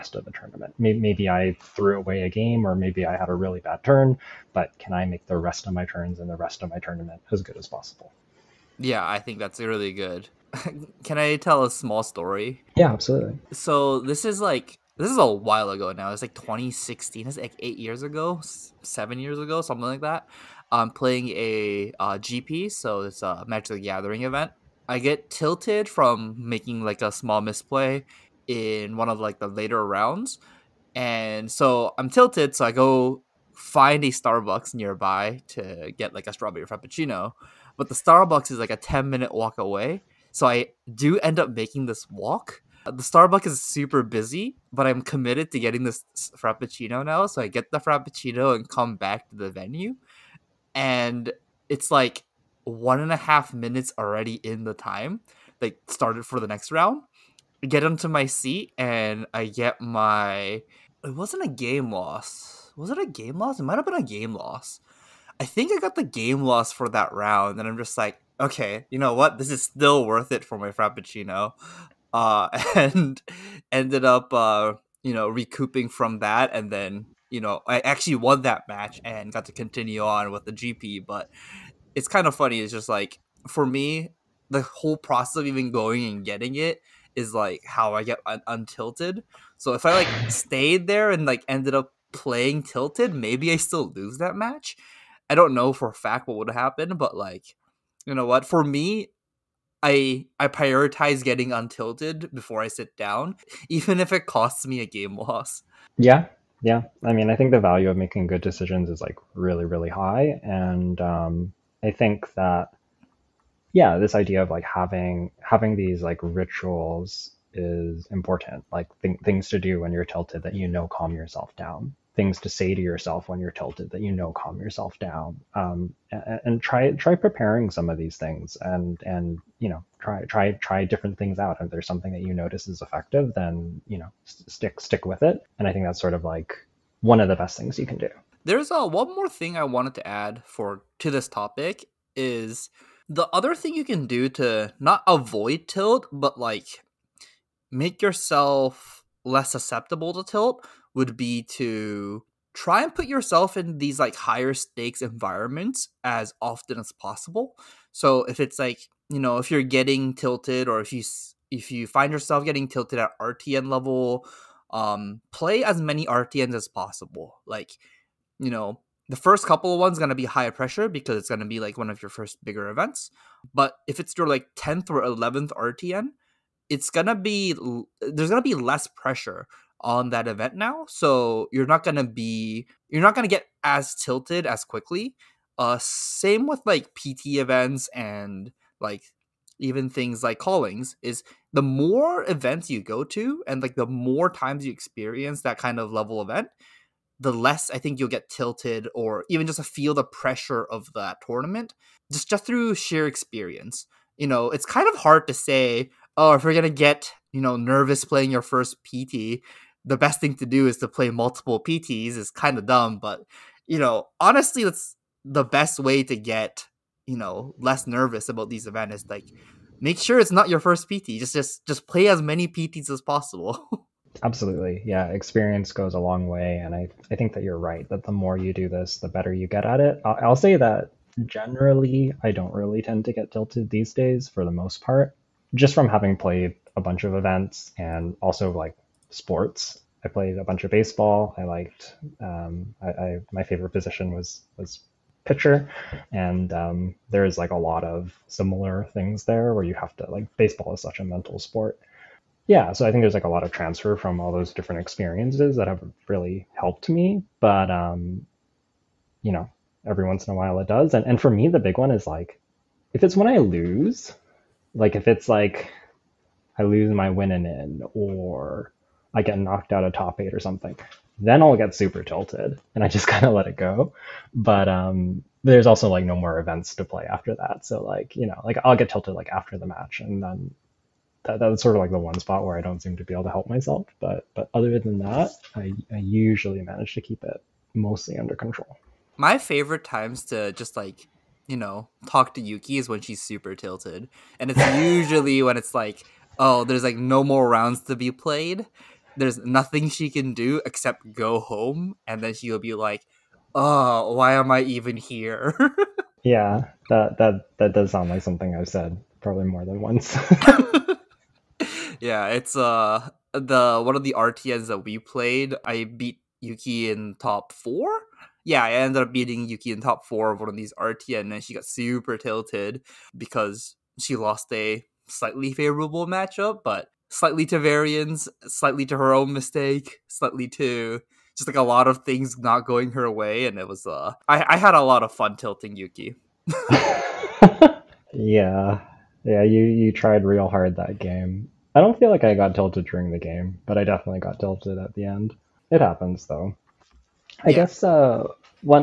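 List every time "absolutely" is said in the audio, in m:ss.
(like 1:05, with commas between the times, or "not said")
0:12, 3:44.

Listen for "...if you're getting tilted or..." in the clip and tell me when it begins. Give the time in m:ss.
2:39.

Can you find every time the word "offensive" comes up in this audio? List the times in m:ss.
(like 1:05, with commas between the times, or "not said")
not said.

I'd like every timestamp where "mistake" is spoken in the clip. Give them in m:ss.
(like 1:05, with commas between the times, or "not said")
5:29.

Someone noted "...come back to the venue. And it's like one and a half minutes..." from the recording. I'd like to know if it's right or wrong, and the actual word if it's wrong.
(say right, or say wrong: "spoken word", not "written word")
right.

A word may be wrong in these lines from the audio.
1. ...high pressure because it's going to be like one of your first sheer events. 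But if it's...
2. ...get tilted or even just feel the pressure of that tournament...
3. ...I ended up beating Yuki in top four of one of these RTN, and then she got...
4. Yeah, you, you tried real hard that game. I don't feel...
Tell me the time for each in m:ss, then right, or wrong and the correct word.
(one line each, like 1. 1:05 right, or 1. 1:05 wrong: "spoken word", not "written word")
1. 2:50 wrong: "bigger", not "sheer"
2. 3:18 right
3. 5:18 right
4. 5:39 right.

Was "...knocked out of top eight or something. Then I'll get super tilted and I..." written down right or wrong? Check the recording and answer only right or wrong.
right.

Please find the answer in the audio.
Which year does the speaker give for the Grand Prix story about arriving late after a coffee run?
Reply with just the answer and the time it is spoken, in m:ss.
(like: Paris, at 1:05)
2016, at 0:16.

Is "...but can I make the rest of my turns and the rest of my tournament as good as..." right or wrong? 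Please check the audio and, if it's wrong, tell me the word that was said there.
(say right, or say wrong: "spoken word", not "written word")
right.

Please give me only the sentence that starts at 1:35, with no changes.
I don't know for a fact what would happen, but like, you know what?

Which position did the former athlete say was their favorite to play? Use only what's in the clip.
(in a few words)
Pitcher.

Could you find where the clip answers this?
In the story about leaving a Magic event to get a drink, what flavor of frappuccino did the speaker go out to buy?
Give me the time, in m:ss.
0:36.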